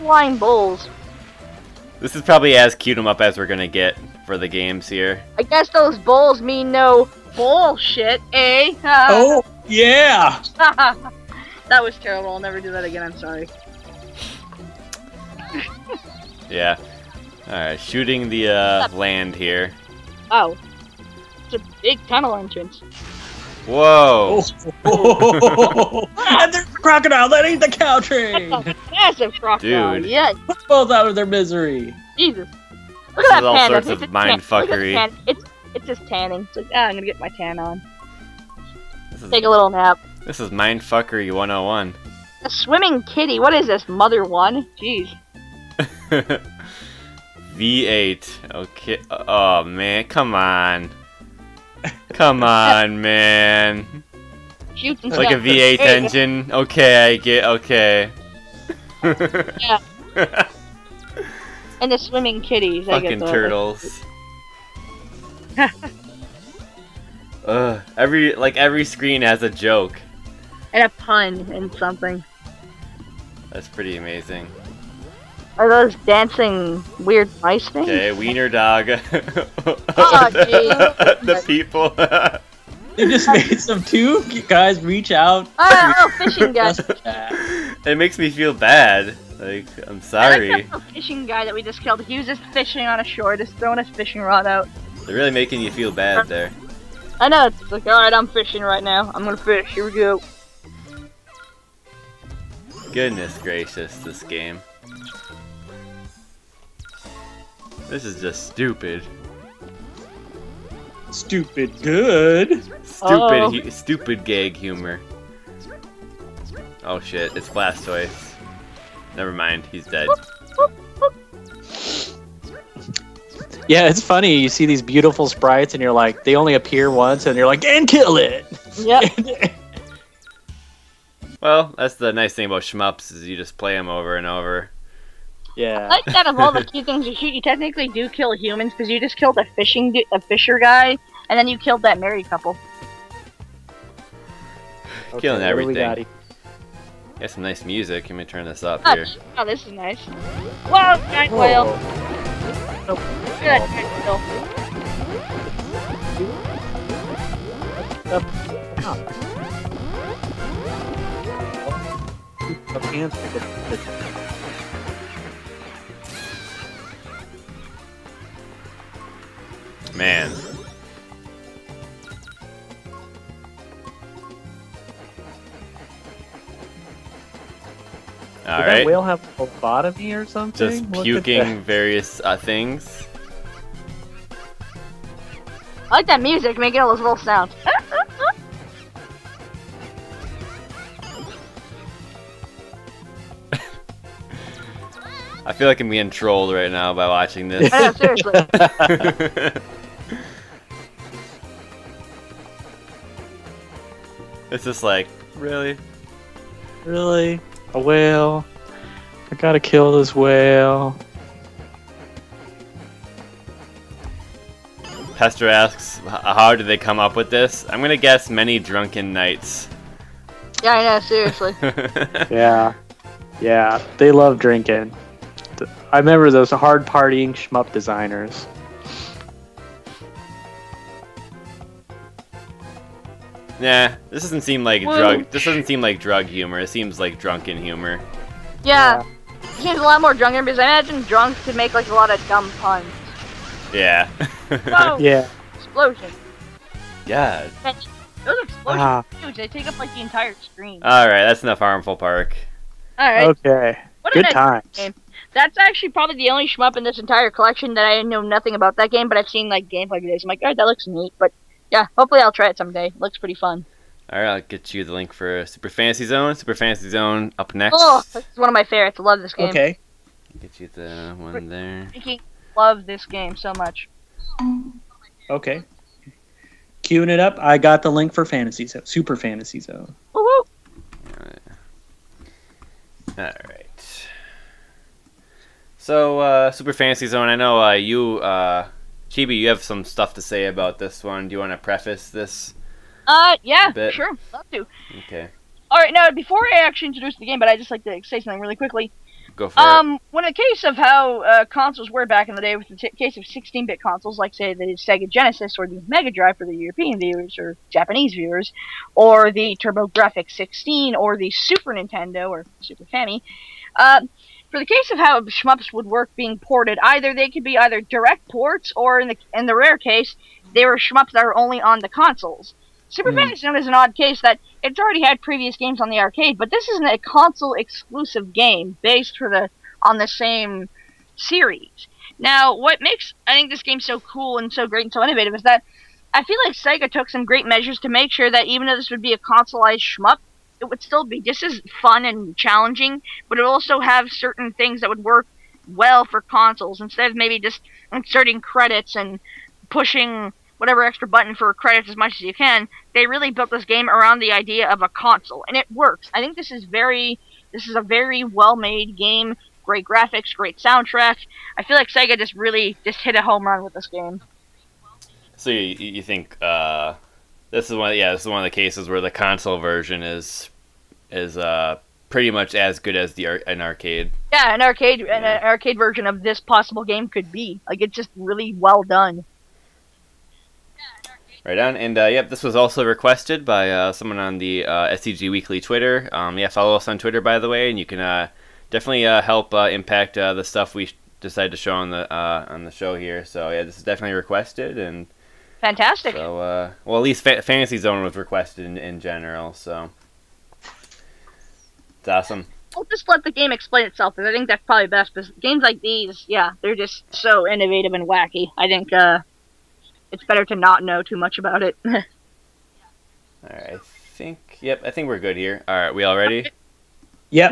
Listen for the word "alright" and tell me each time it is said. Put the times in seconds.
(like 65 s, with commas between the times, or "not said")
17 s, 97 s.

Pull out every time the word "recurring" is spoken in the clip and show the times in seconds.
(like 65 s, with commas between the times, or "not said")
not said.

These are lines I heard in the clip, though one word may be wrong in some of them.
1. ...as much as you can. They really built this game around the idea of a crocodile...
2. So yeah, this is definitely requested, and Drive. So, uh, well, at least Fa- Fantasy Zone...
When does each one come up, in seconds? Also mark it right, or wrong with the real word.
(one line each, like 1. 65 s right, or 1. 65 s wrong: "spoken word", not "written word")
1. 351 s wrong: "console", not "crocodile"
2. 393 s wrong: "Fantastic", not "Drive".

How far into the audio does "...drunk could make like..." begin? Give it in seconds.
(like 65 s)
241 s.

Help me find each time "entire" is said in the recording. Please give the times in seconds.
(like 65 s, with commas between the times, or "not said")
250 s, 256 s.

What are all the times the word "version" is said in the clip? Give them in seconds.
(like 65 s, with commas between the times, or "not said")
369 s, 375 s.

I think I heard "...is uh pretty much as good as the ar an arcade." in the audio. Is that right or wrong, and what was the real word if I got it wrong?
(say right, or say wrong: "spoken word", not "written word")
right.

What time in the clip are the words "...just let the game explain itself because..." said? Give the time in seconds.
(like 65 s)
402 s.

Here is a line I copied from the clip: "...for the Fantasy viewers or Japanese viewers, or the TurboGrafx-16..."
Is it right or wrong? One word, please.
wrong.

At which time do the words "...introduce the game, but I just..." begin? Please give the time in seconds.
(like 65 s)
296 s.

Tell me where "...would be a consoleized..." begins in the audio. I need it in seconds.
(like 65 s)
338 s.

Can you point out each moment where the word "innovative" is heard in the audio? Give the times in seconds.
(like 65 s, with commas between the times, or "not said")
335 s, 407 s.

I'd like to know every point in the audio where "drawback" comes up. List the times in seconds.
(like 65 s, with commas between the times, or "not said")
not said.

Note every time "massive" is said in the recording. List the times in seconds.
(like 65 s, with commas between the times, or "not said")
28 s.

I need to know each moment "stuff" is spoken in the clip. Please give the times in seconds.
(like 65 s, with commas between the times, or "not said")
289 s, 390 s.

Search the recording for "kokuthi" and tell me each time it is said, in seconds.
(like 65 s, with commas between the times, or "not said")
not said.